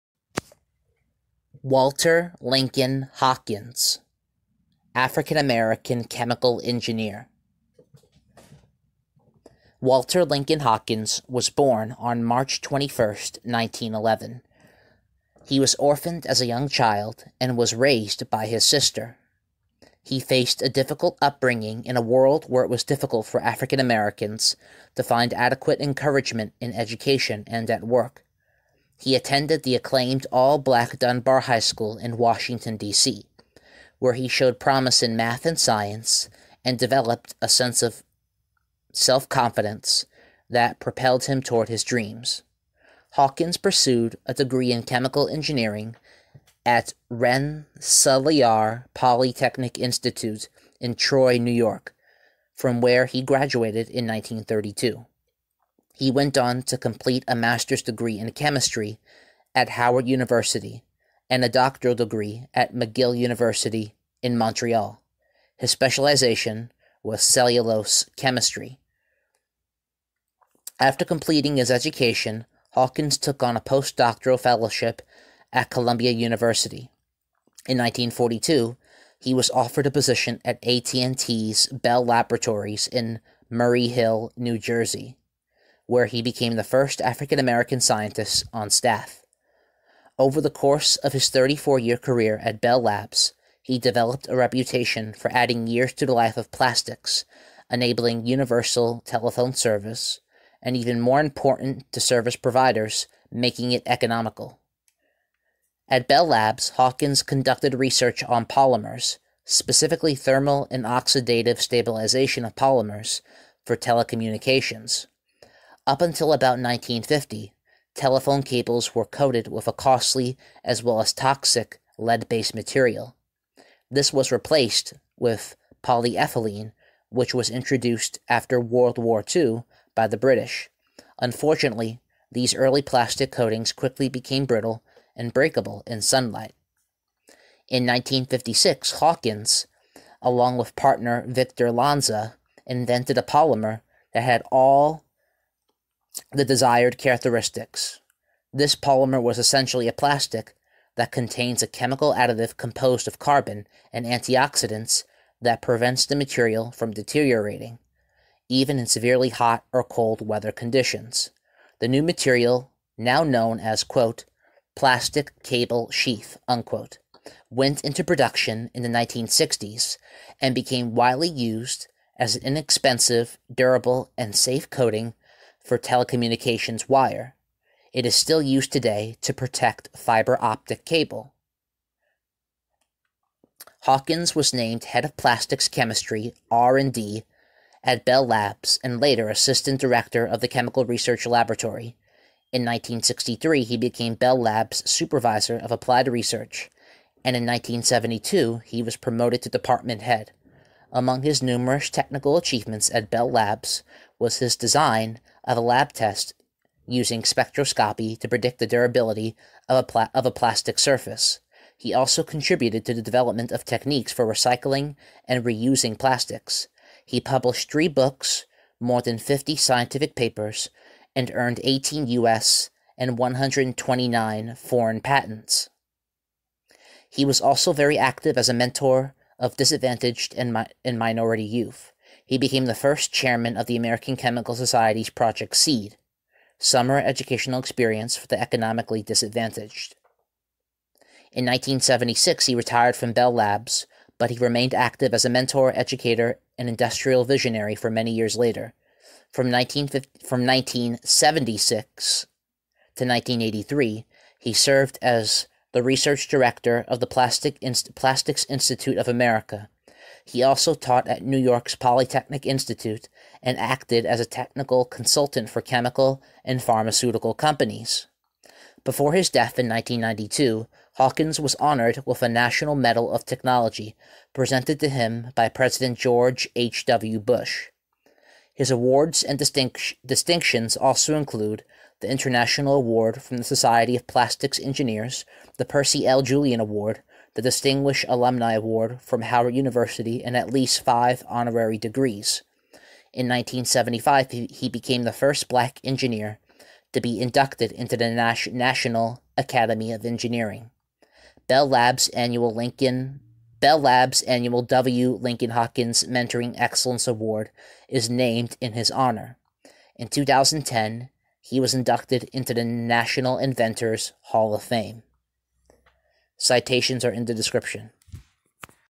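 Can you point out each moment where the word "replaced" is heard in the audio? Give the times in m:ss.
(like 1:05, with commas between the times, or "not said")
2:04.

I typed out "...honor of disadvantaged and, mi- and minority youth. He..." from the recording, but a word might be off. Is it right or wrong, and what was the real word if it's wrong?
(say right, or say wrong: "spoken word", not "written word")
wrong: "mentor", not "honor".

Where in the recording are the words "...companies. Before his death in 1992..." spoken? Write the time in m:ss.
4:27.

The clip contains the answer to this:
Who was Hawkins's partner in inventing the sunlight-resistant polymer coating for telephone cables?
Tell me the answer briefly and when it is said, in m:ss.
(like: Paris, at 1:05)
Victor Lanza, at 2:21.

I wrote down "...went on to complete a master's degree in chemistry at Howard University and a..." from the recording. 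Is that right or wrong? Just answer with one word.
right.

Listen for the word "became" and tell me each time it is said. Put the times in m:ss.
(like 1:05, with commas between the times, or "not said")
1:26, 2:14, 2:50, 3:13, 3:52, 4:54.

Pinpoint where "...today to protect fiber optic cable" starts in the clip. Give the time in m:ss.
2:58.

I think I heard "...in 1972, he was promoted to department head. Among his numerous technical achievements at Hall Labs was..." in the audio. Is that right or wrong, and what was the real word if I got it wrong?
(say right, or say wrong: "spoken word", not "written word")
wrong: "Bell", not "Hall".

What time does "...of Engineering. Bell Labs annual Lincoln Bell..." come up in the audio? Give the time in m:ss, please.
4:59.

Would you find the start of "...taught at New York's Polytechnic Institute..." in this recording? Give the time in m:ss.
4:20.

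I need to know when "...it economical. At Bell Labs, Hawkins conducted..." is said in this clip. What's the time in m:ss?
1:43.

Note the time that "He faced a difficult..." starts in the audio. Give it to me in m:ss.
0:20.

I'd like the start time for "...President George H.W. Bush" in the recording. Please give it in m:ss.
4:35.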